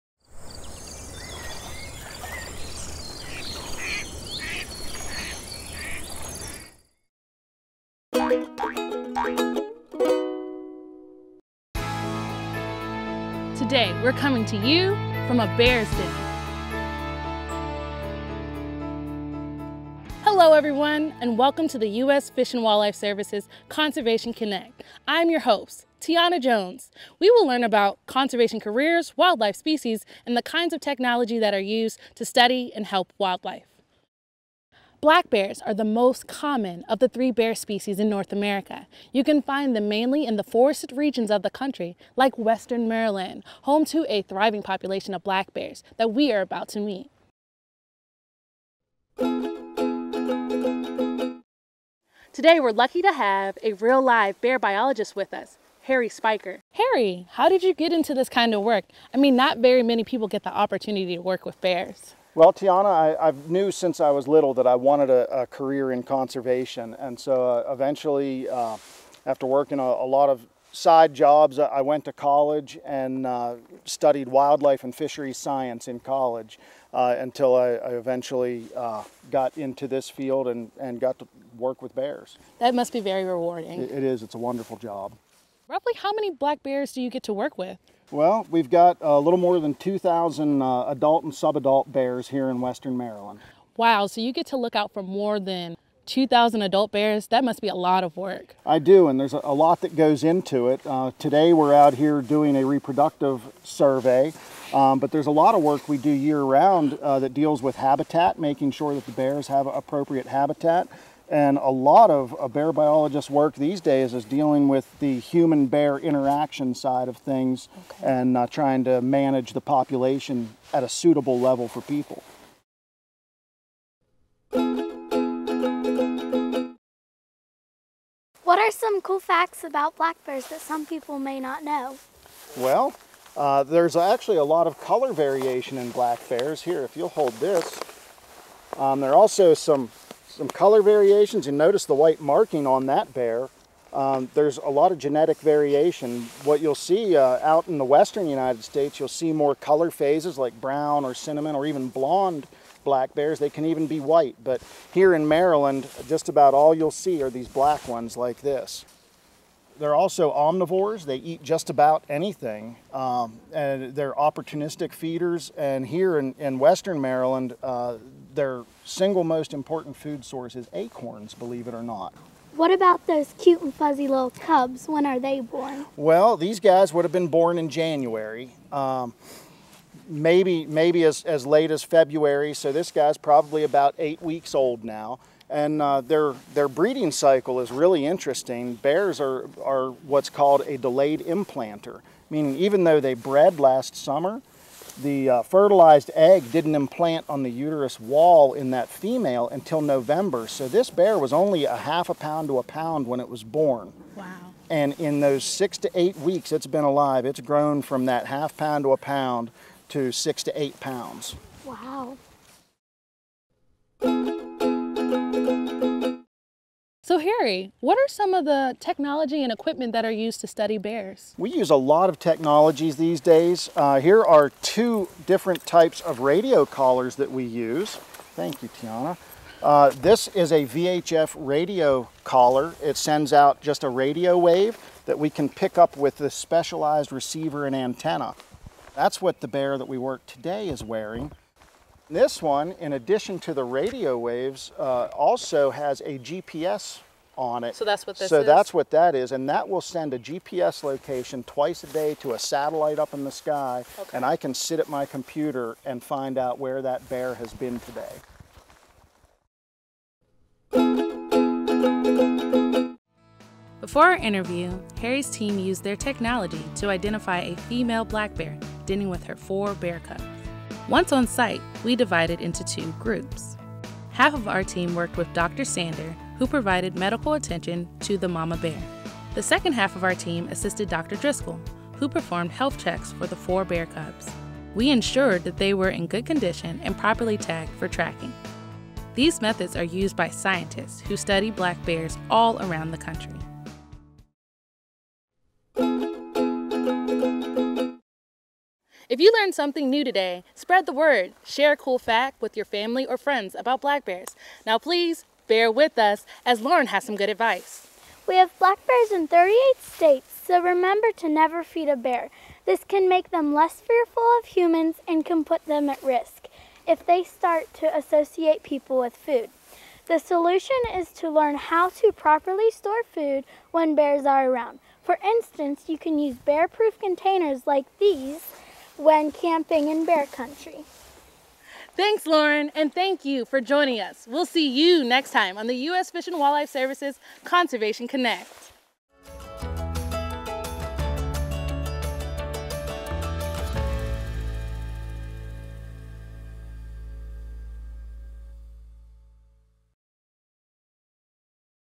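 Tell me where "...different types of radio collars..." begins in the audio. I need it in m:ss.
3:45.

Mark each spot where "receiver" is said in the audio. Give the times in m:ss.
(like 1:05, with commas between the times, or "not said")
3:57.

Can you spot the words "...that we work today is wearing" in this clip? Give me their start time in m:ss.
3:59.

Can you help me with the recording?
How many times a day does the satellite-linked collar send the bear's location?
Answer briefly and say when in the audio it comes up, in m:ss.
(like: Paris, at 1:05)
Twice, at 4:11.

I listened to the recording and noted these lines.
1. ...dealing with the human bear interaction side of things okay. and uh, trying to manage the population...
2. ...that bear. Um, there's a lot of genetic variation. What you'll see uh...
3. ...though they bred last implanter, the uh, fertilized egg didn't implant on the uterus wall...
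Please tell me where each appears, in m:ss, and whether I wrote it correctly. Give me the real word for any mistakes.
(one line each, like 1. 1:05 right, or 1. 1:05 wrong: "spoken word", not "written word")
1. 1:54 right
2. 2:22 right
3. 3:12 wrong: "summer", not "implanter".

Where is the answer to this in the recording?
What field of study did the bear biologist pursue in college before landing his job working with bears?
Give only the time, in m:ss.
1:14.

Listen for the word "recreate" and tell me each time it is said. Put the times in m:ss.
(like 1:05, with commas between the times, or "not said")
not said.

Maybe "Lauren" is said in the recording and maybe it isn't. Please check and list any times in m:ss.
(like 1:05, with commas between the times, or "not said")
5:06, 5:32.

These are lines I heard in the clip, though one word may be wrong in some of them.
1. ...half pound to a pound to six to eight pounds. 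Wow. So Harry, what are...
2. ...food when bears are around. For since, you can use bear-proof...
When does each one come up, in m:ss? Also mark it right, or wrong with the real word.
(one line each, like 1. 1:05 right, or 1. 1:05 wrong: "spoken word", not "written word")
1. 3:28 right
2. 5:23 wrong: "instance", not "since".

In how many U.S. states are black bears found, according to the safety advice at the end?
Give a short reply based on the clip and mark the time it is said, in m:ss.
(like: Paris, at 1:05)
38, at 5:09.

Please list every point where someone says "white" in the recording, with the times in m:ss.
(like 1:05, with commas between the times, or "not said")
2:21, 2:33.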